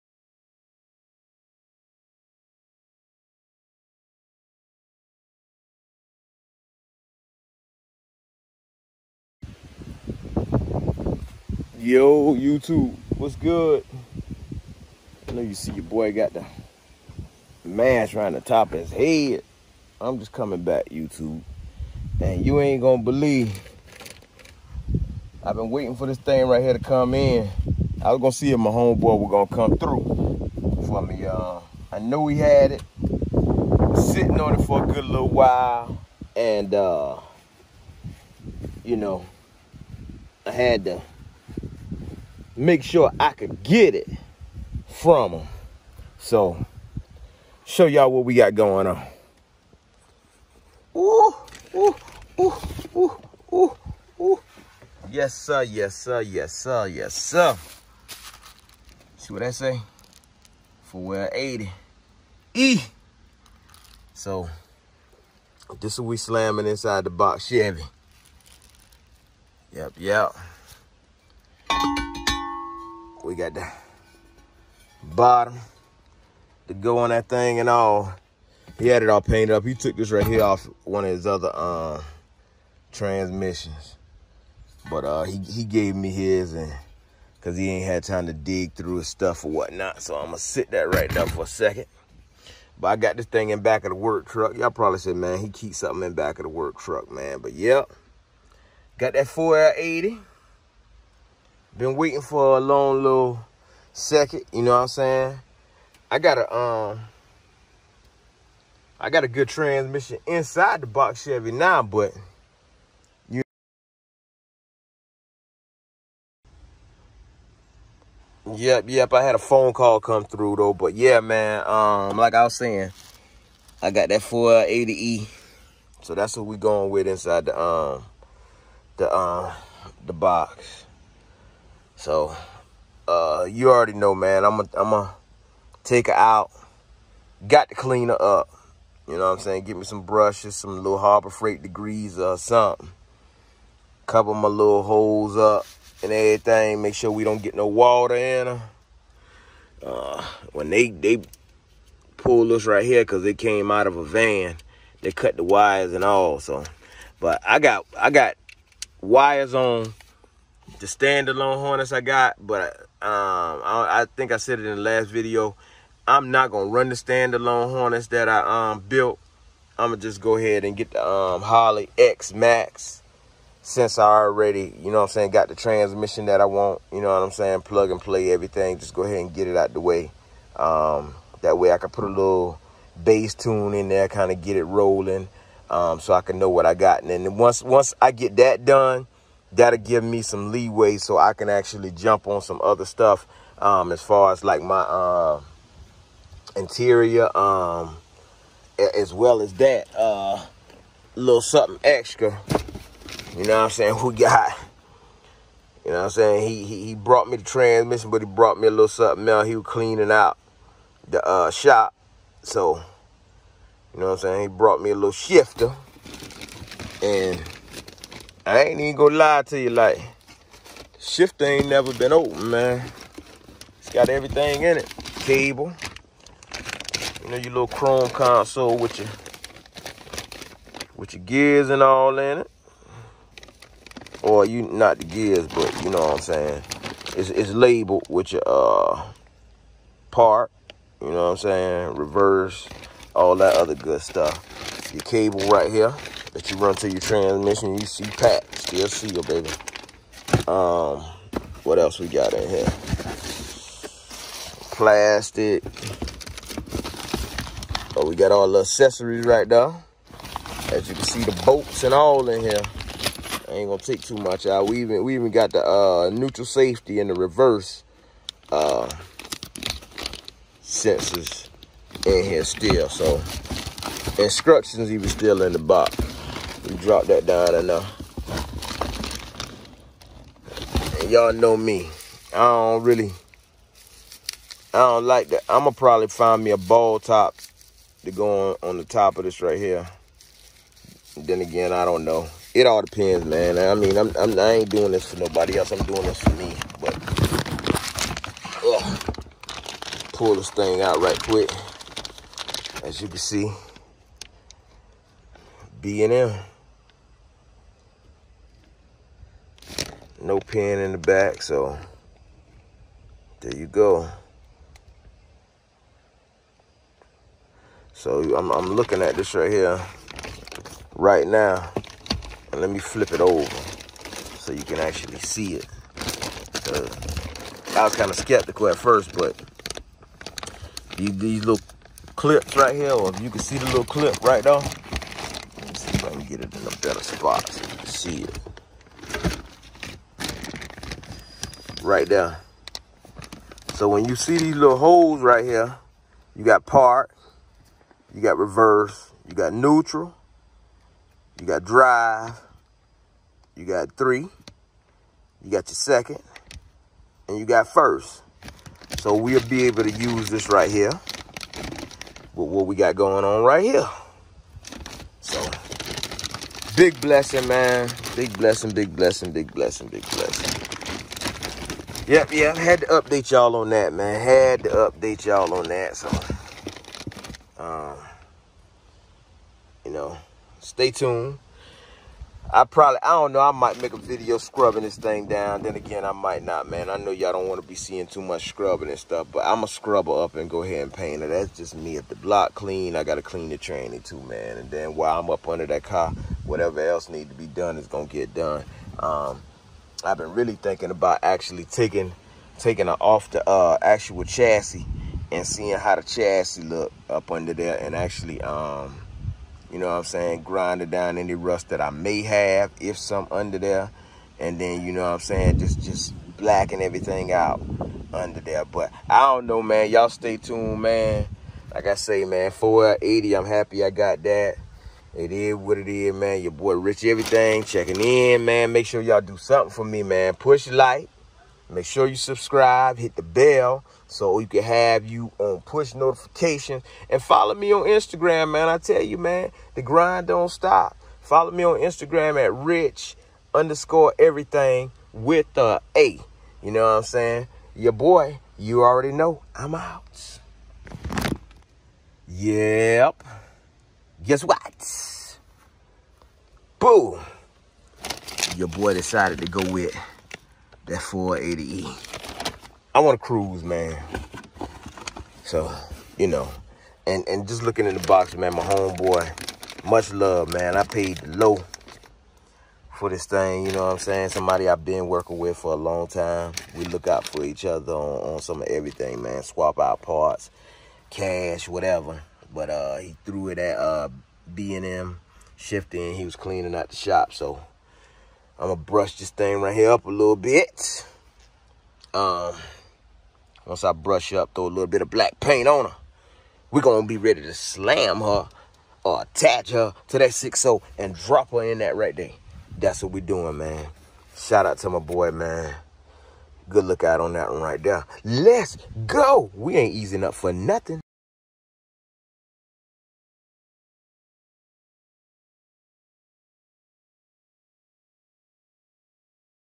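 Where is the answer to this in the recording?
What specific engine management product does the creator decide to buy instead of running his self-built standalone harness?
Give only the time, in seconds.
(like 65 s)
171 s.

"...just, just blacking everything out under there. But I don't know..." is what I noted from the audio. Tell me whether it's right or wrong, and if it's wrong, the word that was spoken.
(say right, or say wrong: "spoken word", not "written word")
right.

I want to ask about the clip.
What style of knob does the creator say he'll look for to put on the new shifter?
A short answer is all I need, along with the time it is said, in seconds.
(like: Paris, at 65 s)
ball top, at 286 s.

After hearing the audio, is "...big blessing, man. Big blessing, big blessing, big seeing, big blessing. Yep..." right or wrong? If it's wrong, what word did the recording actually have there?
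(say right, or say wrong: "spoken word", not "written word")
wrong: "blessing", not "seeing".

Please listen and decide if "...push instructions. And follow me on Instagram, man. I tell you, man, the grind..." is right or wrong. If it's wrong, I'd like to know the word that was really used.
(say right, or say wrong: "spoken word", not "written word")
wrong: "notifications", not "instructions".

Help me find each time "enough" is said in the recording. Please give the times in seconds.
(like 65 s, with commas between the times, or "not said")
277 s.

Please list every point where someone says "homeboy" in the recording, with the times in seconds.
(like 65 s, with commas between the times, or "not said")
28 s, 468 s.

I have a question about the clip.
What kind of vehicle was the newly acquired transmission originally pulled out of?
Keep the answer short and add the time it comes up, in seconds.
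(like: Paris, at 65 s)
a van, at 153 s.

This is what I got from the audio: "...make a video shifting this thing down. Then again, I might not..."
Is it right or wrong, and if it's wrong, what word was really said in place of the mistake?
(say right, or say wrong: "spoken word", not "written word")
wrong: "scrubbing", not "shifting".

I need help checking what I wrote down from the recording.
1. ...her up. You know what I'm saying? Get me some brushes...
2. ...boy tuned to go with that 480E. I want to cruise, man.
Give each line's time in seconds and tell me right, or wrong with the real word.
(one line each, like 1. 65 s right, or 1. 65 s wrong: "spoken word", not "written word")
1. 138 s right
2. 458 s wrong: "decided", not "tuned".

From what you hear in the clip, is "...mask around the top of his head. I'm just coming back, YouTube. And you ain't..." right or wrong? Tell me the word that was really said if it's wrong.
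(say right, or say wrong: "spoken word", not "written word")
right.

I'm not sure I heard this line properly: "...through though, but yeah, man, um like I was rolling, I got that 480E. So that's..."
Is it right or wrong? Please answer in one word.
wrong.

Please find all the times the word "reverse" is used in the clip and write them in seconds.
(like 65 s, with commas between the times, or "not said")
241 s, 267 s, 348 s.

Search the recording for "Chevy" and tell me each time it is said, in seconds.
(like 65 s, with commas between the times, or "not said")
67 s, 111 s.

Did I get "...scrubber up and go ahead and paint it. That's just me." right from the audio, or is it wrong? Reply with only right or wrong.
right.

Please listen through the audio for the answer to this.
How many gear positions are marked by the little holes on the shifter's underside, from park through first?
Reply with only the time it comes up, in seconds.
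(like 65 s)
346 s.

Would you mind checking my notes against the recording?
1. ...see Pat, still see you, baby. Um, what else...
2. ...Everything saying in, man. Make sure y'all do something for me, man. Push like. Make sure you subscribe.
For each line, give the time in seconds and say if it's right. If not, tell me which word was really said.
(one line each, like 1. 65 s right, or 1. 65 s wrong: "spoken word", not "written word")
1. 247 s right
2. 427 s wrong: "checking", not "saying".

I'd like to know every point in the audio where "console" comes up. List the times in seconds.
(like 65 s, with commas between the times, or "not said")
228 s.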